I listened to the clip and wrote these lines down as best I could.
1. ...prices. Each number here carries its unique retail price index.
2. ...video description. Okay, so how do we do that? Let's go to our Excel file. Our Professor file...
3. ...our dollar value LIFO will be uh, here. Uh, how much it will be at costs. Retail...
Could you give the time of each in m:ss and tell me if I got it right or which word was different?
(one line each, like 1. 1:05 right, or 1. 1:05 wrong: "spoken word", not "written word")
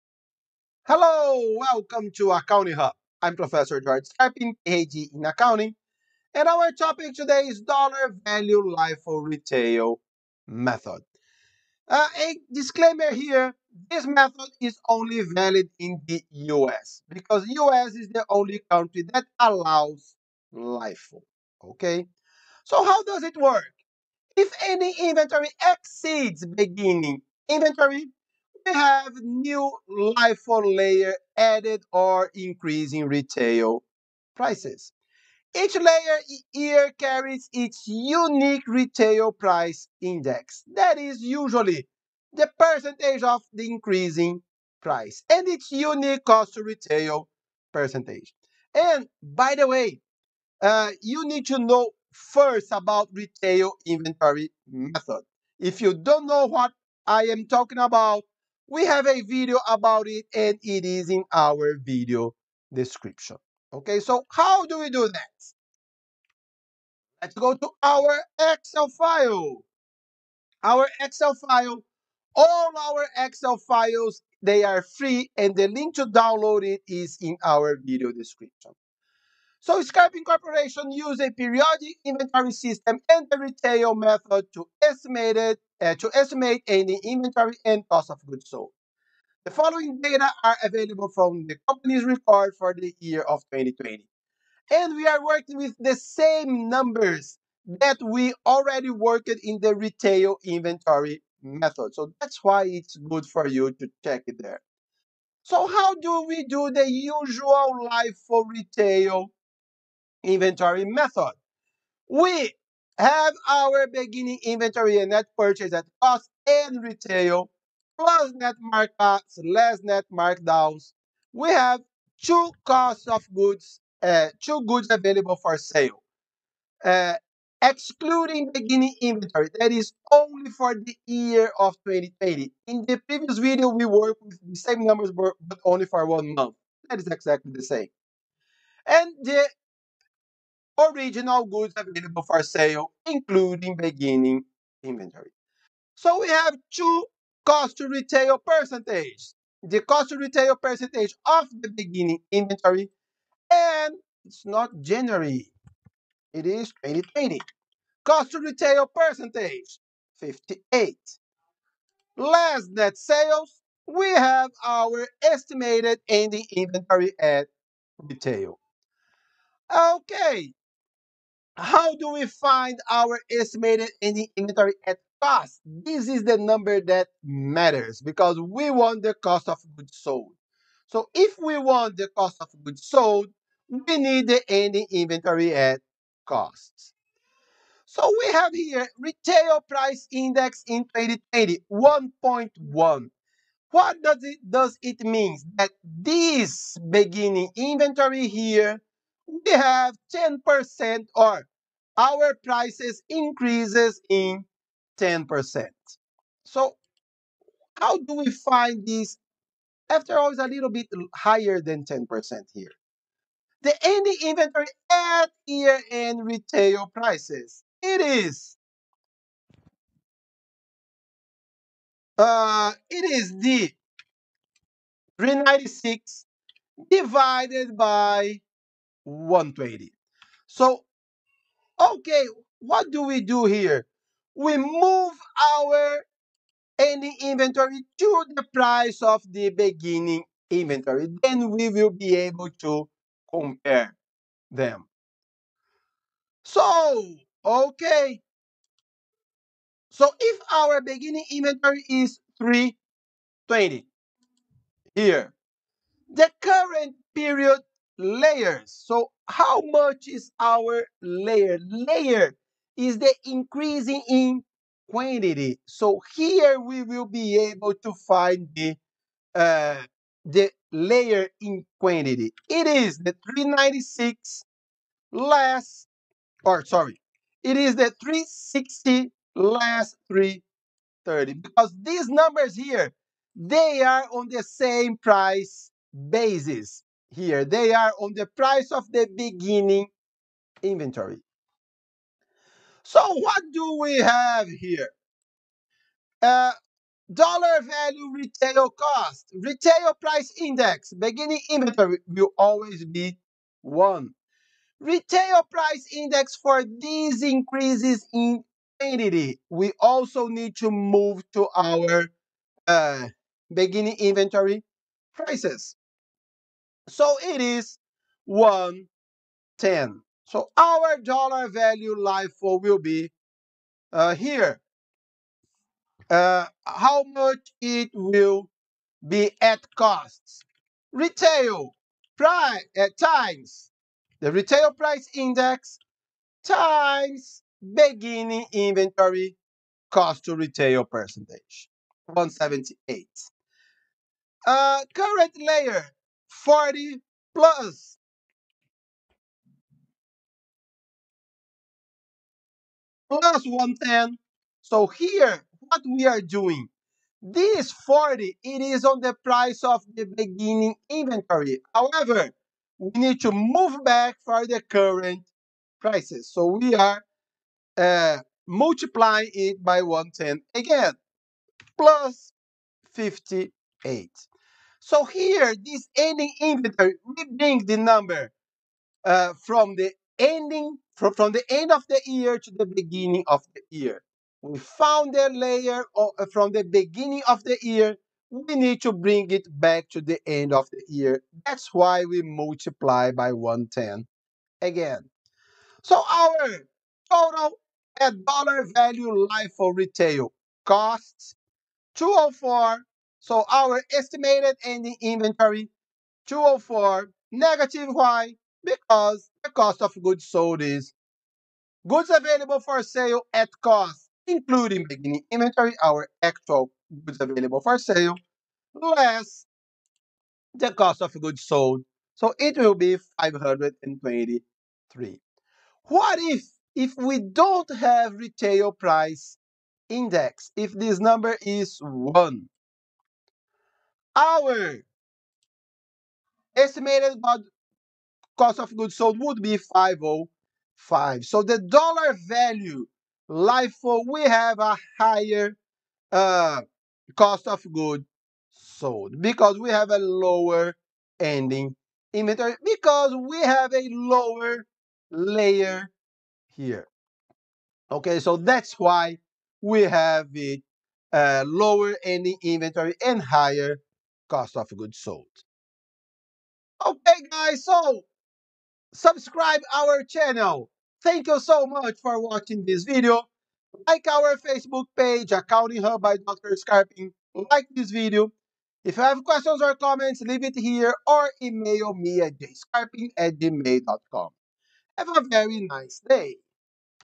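1. 0:34 wrong: "layer", not "number"
2. 1:01 wrong: "Excel", not "Professor"
3. 5:20 right.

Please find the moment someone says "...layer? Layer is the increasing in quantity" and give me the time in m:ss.
4:21.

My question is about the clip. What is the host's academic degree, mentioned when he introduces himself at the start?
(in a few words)
PhD in accounting.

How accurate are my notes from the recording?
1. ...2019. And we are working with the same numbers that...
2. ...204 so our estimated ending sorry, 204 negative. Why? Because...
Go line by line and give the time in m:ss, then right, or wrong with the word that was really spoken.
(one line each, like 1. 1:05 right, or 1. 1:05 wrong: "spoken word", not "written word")
1. 1:33 wrong: "2020", not "2019"
2. 6:41 wrong: "inventory", not "sorry".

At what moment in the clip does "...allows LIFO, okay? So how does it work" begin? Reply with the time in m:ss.
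0:19.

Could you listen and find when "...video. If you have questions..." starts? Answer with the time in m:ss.
7:57.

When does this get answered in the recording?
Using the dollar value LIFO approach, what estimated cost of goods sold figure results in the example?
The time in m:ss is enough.
7:03.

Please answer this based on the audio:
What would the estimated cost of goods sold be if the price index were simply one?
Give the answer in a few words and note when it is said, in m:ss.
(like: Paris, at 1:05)
505, at 7:19.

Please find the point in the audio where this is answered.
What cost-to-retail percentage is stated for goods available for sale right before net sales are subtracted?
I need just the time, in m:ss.
2:38.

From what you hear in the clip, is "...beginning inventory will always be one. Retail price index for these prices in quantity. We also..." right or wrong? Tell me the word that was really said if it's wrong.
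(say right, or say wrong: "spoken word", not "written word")
wrong: "increases", not "prices".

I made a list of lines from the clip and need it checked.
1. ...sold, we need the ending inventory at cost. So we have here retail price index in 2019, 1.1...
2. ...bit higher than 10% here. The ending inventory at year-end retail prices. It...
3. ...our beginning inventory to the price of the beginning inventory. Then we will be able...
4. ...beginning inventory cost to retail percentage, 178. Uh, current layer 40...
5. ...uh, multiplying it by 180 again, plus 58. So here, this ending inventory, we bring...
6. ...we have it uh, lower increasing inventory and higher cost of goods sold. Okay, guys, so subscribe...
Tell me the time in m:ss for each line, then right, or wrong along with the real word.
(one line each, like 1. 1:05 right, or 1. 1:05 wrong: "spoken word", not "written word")
1. 3:02 wrong: "2020", not "2019"
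2. 3:30 right
3. 3:55 wrong: "ending", not "beginning"
4. 5:37 right
5. 6:07 wrong: "110", not "180"
6. 7:39 wrong: "ending", not "increasing".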